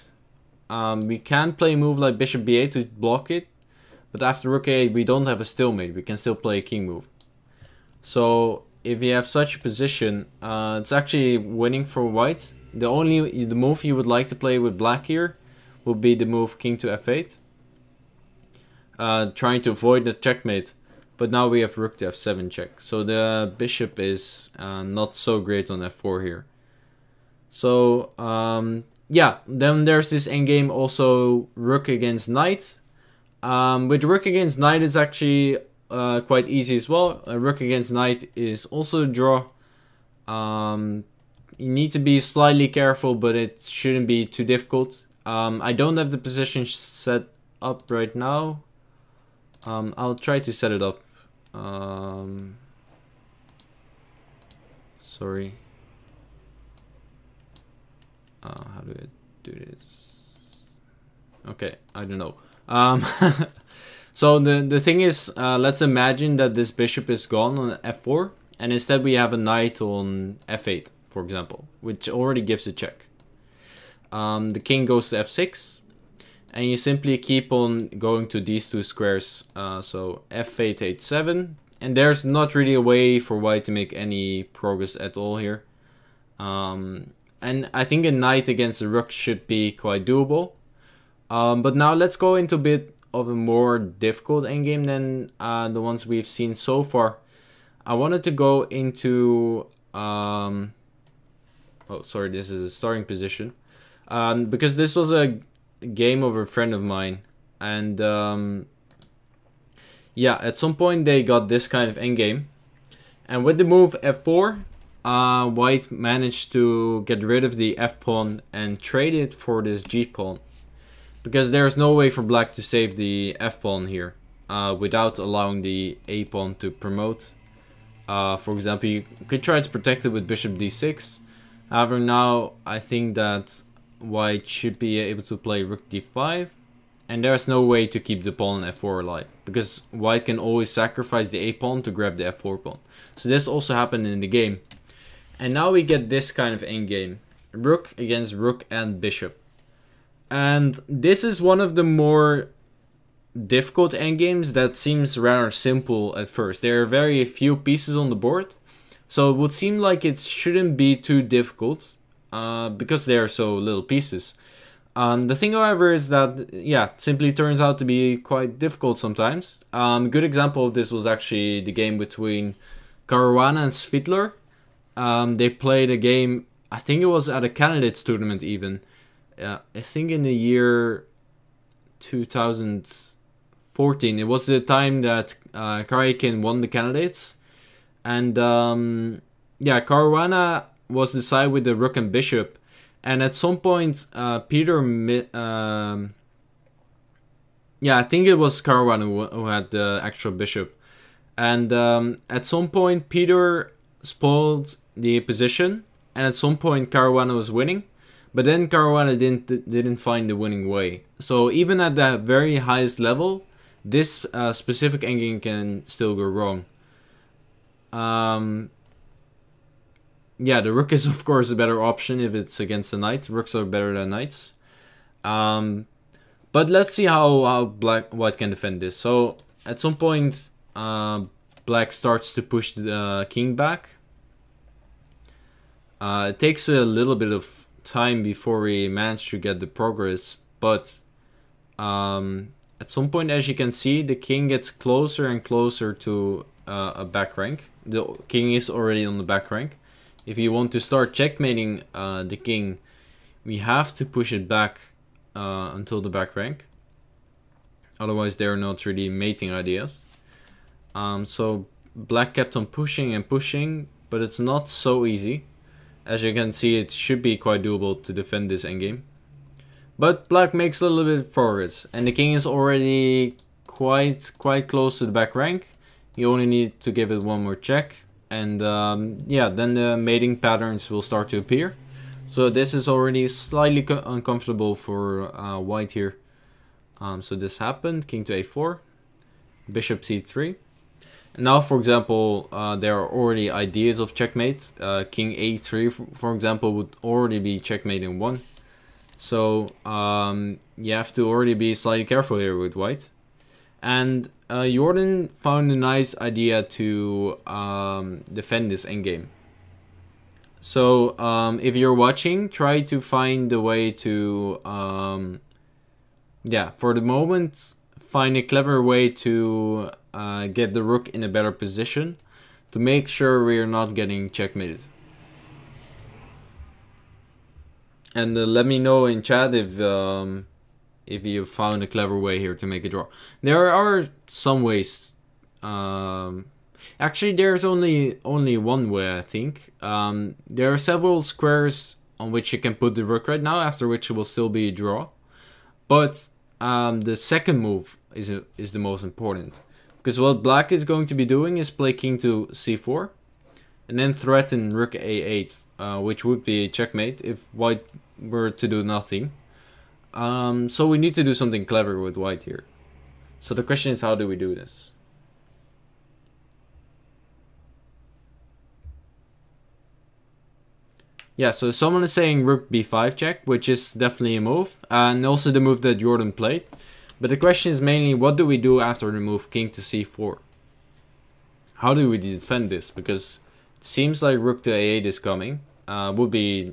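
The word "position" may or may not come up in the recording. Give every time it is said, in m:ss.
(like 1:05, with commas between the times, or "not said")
0:09, 0:46, 1:43, 3:25, 5:21.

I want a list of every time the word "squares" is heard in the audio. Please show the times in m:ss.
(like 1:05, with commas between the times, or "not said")
1:18, 5:41.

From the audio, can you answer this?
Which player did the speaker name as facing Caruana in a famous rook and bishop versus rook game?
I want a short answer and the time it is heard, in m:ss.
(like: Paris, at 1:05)
Svidler, at 2:53.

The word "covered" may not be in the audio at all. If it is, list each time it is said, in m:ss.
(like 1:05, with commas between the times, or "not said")
not said.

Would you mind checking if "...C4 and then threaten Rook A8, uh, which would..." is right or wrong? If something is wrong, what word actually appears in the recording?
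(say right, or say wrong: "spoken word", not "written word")
right.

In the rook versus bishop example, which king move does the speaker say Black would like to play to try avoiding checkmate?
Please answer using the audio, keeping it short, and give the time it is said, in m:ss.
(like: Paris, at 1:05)
King to f8, at 0:16.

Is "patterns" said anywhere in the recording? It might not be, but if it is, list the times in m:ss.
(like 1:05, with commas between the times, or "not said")
4:40.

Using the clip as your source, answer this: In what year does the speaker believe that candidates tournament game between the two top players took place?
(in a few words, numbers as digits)
2014.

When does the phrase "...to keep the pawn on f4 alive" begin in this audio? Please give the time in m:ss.
2:17.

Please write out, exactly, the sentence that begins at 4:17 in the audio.
Otherwise, they're not really mating ideas.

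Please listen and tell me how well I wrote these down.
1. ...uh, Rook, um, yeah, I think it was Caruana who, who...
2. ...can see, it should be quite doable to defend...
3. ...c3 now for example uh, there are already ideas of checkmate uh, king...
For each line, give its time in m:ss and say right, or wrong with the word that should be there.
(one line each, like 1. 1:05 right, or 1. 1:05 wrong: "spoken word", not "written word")
1. 3:14 wrong: "Peter", not "Rook"
2. 4:26 right
3. 4:50 right.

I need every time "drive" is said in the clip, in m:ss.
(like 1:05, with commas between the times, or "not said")
not said.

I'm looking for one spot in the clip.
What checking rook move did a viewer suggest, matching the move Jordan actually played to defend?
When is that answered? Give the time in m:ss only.
6:12.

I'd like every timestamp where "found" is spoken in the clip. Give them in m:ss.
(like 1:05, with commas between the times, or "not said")
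5:05, 5:31.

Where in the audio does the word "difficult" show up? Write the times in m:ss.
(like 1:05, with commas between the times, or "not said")
0:44, 1:33, 2:33, 2:41, 2:48.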